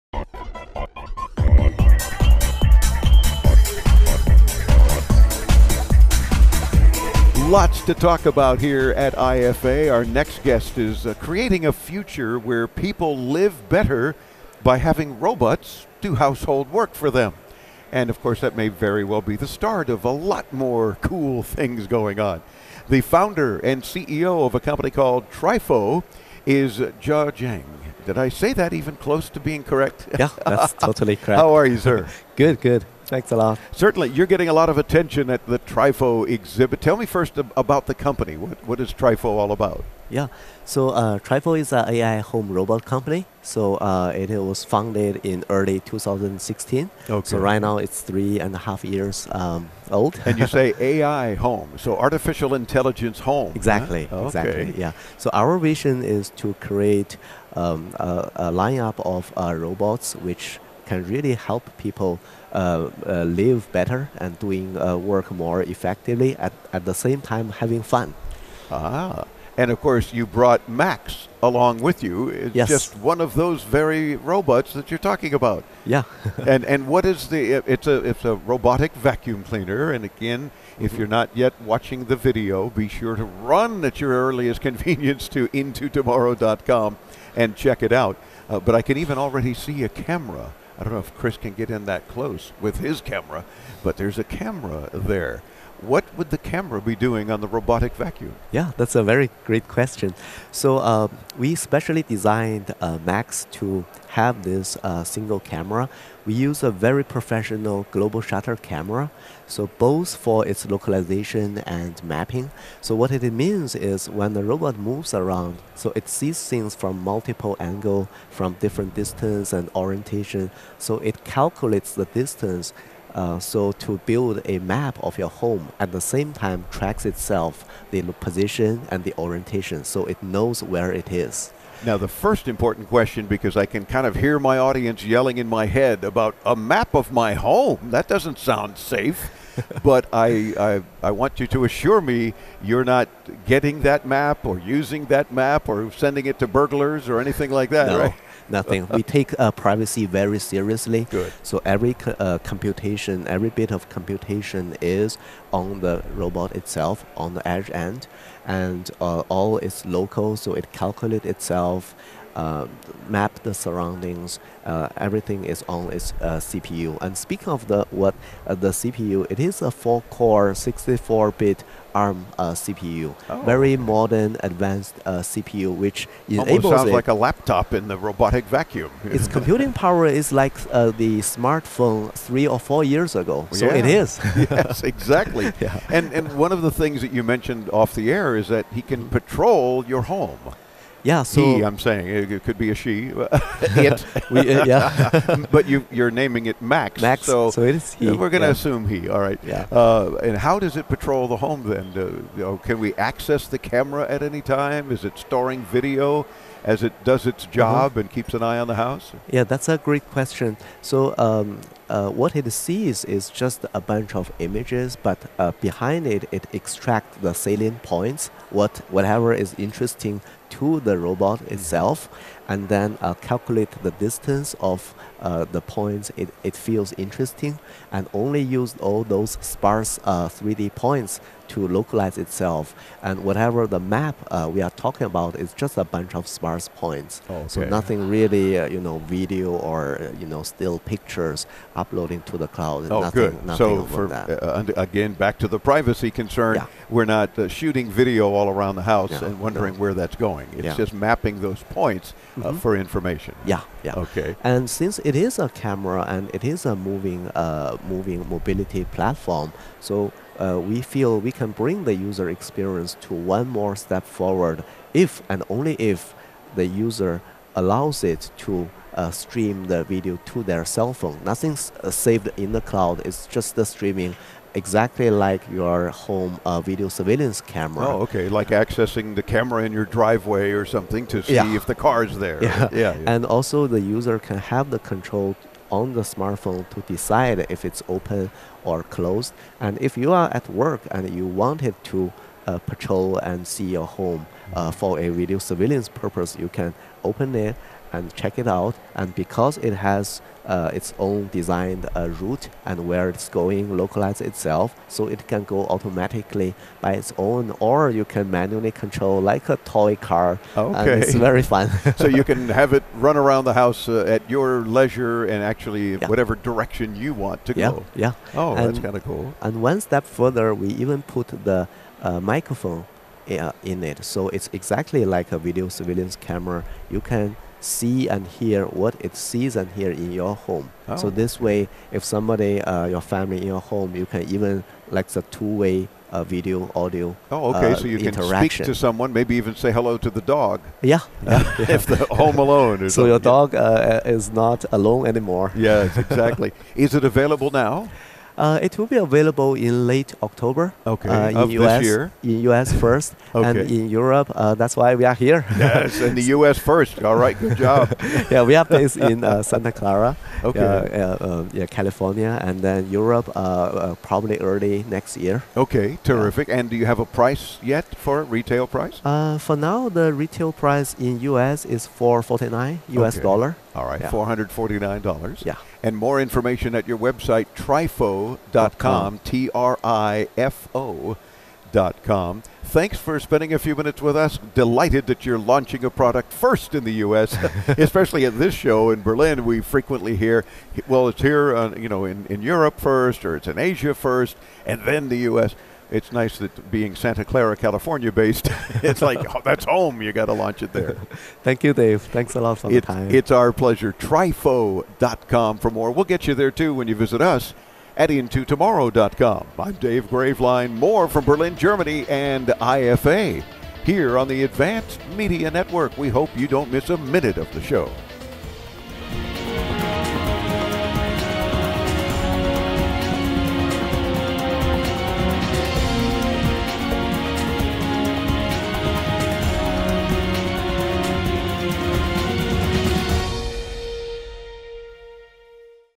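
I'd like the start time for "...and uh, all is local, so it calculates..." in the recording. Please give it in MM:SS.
02:38.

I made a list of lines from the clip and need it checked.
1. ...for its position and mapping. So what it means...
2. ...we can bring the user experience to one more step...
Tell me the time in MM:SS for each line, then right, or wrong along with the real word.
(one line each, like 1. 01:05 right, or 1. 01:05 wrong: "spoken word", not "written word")
1. 01:50 wrong: "localization", not "position"
2. 04:21 right.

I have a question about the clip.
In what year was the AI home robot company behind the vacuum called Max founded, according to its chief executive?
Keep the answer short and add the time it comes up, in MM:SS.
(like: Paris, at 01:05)
2016, at 00:45.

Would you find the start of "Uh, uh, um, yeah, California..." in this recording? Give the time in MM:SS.
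06:00.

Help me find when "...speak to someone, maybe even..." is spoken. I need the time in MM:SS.
05:38.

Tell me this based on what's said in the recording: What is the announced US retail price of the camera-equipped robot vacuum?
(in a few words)
$449.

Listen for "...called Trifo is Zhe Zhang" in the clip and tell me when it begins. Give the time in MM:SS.
00:24.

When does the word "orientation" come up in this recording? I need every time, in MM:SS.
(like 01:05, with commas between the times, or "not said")
01:59, 02:09.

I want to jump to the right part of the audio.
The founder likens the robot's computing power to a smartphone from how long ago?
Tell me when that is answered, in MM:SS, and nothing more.
03:02.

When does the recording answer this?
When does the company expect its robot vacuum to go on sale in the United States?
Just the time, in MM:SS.
05:49.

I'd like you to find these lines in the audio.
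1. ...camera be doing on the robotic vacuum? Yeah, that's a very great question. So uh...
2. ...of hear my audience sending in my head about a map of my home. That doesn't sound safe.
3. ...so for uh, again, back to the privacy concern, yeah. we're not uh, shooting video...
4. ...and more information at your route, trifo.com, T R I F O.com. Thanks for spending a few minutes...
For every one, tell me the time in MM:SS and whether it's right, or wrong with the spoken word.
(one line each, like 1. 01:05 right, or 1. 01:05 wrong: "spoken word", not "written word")
1. 01:36 right
2. 02:14 wrong: "yelling", not "sending"
3. 04:03 right
4. 06:15 wrong: "website", not "route".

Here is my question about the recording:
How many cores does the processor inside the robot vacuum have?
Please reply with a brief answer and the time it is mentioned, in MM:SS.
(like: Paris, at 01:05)
4, at 02:49.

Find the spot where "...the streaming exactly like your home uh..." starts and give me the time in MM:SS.
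04:33.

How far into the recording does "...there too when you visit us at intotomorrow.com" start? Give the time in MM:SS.
06:46.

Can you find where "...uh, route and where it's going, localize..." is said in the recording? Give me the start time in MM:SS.
05:01.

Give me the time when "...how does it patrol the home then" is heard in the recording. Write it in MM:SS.
03:20.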